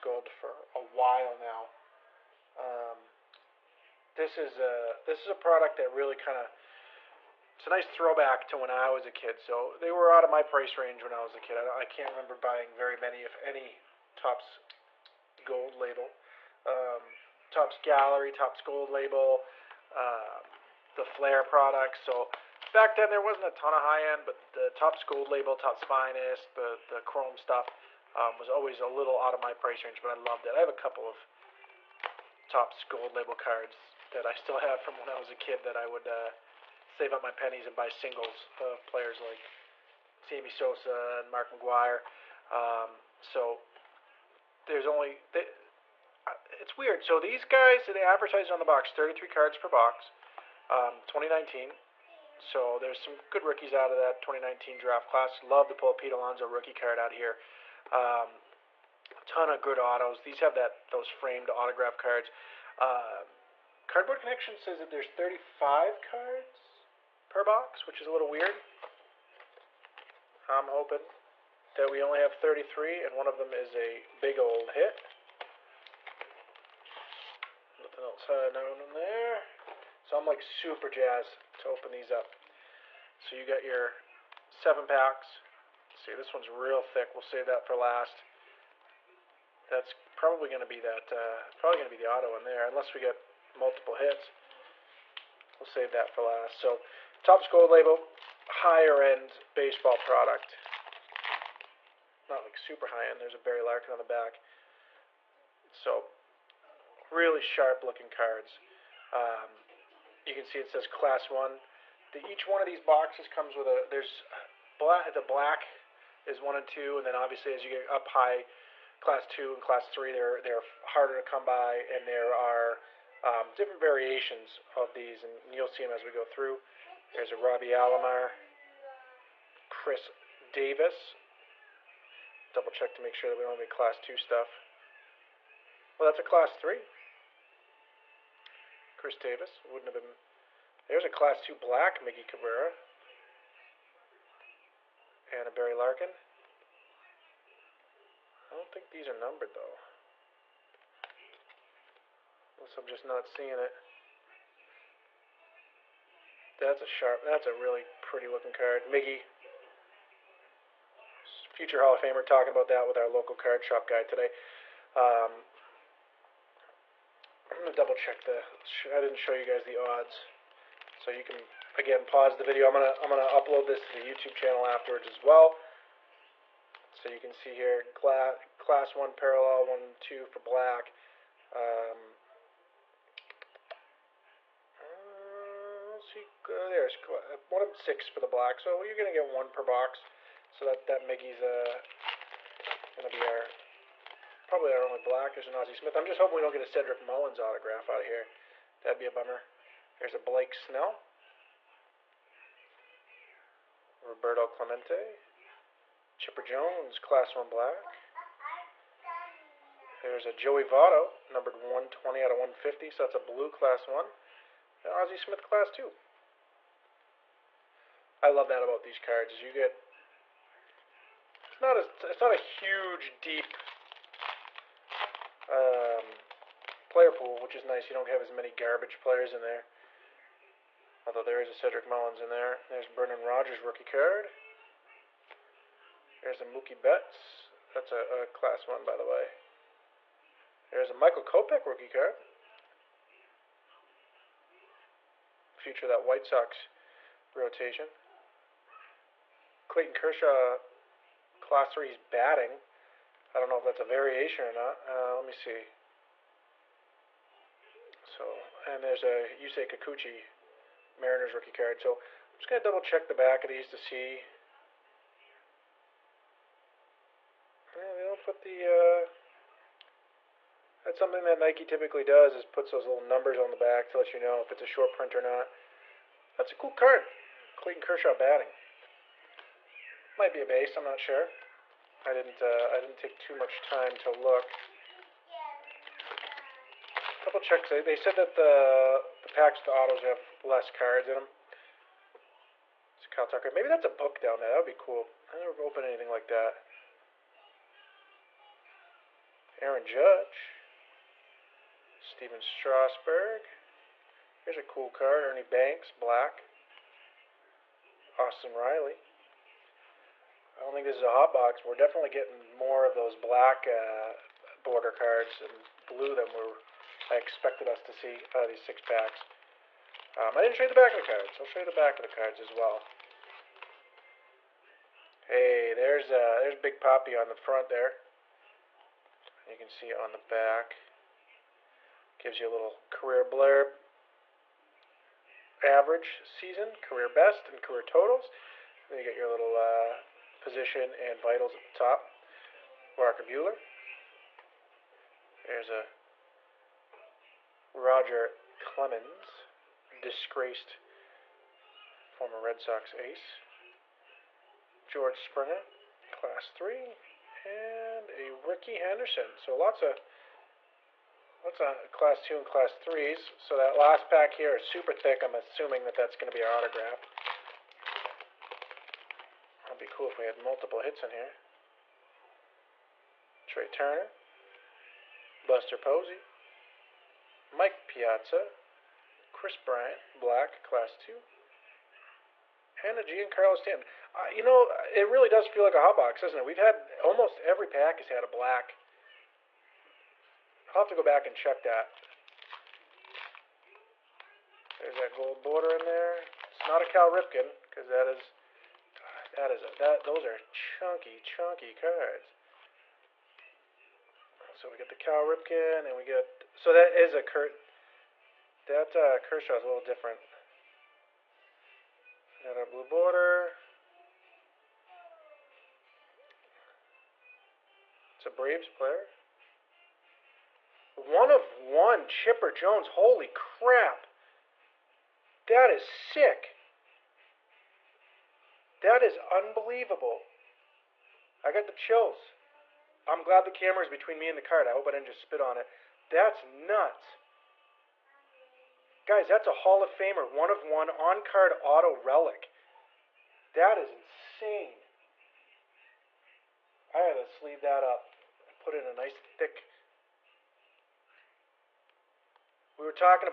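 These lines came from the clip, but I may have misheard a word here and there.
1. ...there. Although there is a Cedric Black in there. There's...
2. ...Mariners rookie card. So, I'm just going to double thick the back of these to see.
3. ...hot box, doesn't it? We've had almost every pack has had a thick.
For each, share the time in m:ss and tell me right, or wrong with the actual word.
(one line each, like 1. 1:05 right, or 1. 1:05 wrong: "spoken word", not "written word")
1. 3:49 wrong: "Mullins", not "Black"
2. 4:20 wrong: "check", not "thick"
3. 6:25 wrong: "black", not "thick".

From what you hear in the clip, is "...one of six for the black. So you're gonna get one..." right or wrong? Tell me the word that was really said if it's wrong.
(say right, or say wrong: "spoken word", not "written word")
right.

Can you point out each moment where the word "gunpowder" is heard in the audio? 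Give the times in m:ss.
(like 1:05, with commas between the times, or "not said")
not said.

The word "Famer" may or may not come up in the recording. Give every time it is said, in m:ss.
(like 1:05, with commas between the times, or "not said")
2:42, 7:19.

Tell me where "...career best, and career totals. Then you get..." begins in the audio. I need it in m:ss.
5:36.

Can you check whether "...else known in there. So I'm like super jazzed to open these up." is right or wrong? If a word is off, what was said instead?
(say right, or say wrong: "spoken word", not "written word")
right.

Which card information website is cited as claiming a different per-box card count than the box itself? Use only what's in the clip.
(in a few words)
Cardboard Connection.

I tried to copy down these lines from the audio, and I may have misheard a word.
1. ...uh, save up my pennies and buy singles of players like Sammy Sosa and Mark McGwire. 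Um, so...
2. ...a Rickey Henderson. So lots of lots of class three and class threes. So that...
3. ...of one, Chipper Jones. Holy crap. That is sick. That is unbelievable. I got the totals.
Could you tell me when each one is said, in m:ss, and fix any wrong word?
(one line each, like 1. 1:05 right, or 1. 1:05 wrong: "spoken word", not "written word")
1. 0:36 right
2. 5:58 wrong: "two", not "three"
3. 7:01 wrong: "chills", not "totals".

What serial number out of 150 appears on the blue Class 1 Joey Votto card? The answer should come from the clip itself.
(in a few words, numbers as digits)
120.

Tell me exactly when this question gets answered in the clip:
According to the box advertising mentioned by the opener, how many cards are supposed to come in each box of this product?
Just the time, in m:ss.
0:48.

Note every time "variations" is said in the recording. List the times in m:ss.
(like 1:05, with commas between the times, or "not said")
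2:03, 4:13.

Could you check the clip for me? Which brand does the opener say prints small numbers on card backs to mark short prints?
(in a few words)
Nike.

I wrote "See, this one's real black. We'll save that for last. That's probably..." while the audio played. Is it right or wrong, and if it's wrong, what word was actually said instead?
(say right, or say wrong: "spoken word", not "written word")
wrong: "thick", not "black".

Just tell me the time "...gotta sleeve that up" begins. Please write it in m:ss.
7:26.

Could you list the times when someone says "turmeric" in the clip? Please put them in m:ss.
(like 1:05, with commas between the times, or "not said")
not said.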